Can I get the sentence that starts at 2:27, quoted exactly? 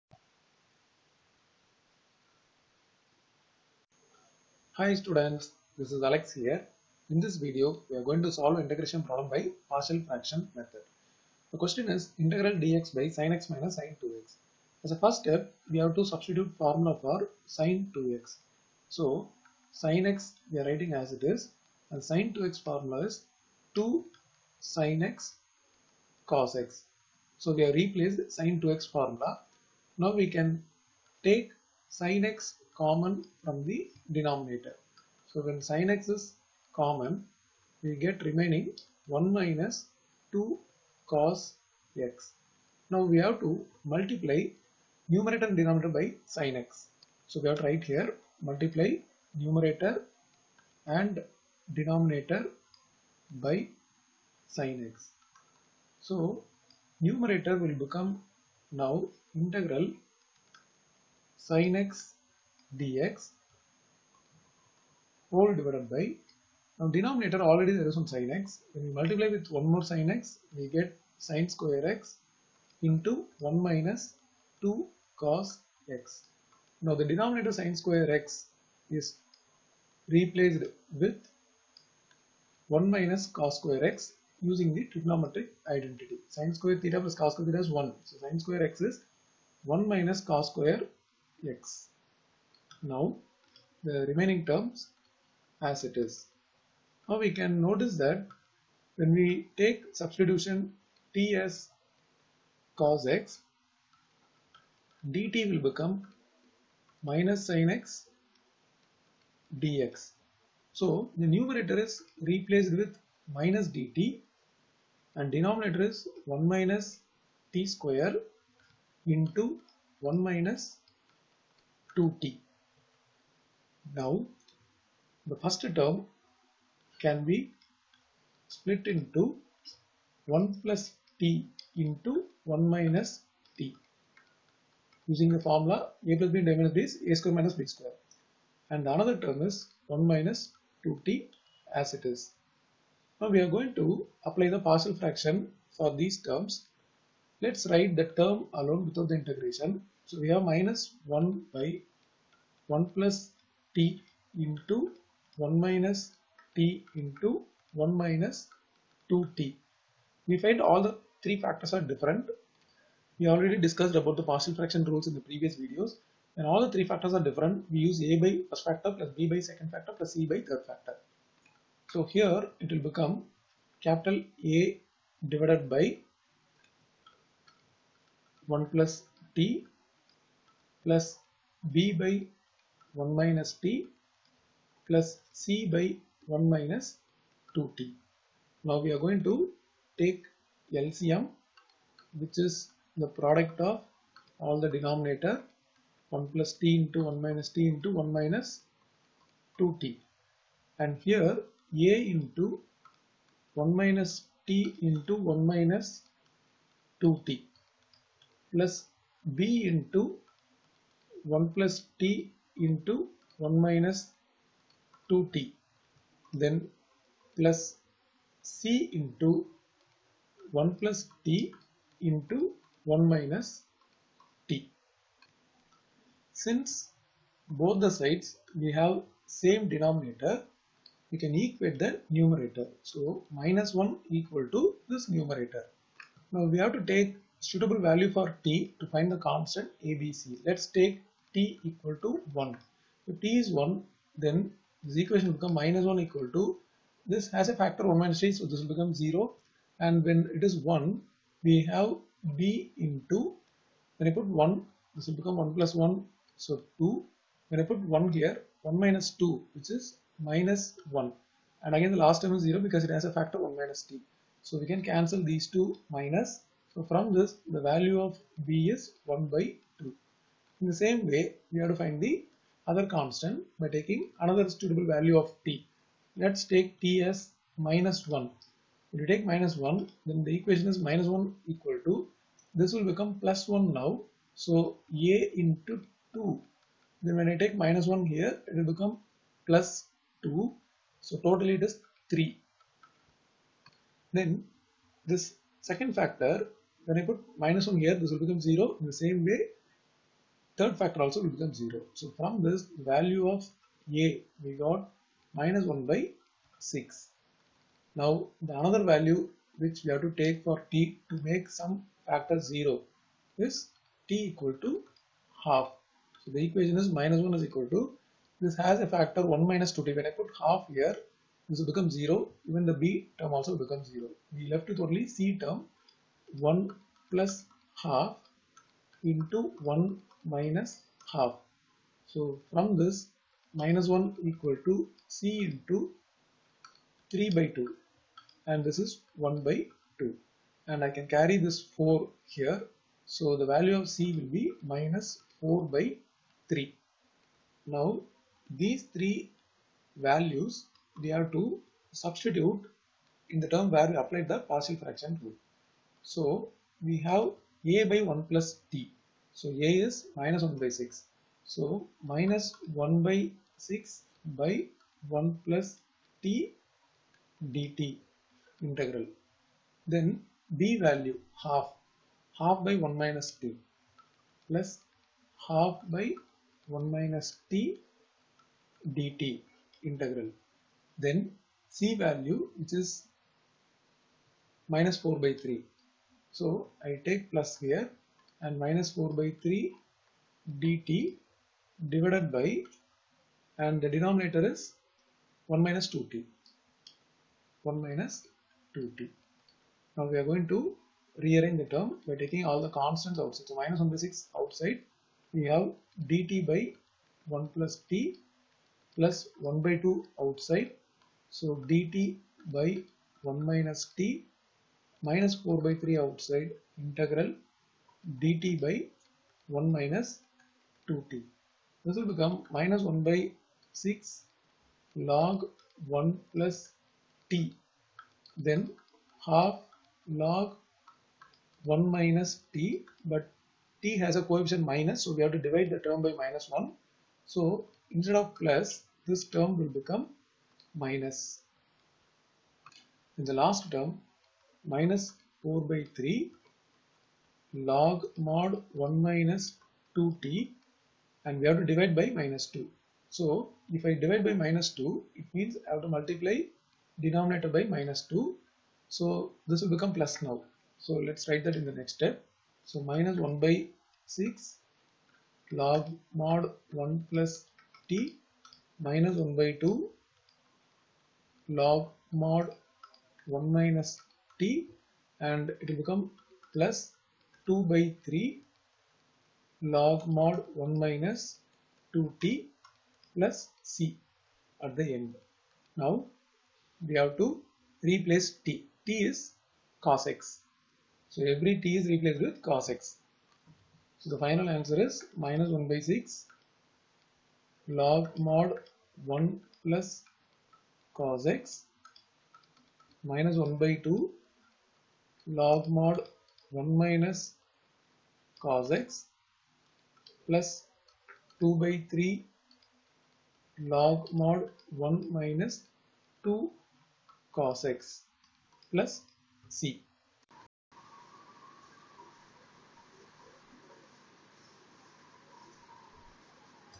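Let's write the term alone without the integration.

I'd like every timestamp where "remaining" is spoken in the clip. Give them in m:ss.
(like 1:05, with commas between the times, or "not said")
0:38, 1:34.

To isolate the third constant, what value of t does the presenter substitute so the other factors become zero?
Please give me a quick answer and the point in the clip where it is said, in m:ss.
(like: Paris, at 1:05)
1/2, at 5:14.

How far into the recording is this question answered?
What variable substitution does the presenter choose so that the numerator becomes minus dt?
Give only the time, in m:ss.
1:41.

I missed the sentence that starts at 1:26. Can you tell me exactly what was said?
Sine square theta plus cos square theta is 1.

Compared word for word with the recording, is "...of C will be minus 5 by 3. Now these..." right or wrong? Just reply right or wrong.
wrong.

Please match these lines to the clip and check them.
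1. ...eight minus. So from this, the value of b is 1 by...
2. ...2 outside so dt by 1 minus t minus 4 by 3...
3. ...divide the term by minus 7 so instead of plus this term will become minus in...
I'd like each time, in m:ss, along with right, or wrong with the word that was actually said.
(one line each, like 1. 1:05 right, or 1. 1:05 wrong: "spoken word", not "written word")
1. 4:25 wrong: "two", not "eight"
2. 6:49 right
3. 7:15 wrong: "1", not "7".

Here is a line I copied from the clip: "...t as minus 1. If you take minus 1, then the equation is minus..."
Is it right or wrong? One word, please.
right.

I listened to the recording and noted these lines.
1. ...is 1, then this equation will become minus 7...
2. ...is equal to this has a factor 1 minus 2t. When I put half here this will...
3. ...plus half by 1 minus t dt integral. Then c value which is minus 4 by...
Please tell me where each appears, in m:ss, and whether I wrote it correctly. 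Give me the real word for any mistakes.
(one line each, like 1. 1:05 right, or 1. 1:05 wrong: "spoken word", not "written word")
1. 4:03 wrong: "1", not "7"
2. 5:17 right
3. 6:14 right.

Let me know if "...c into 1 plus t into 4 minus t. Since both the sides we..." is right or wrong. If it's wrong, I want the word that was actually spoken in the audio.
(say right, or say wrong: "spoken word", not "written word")
wrong: "1", not "4".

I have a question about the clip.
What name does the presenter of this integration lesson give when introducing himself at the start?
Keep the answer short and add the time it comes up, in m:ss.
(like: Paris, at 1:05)
Alex, at 0:06.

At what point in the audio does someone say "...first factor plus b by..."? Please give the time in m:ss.
2:48.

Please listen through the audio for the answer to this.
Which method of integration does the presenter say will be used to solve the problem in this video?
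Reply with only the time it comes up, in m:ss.
0:09.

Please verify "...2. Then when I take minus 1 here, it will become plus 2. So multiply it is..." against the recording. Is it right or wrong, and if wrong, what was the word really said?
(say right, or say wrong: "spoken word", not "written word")
wrong: "totally", not "multiply".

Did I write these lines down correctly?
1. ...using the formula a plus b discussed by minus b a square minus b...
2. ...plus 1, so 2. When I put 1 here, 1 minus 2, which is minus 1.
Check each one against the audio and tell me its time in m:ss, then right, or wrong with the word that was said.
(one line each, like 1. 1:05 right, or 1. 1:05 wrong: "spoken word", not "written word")
1. 2:15 wrong: "divided", not "discussed"
2. 4:15 right.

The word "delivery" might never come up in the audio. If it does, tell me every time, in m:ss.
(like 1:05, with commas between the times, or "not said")
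not said.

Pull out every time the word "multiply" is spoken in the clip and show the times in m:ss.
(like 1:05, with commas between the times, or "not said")
0:43, 0:48, 1:08, 7:35.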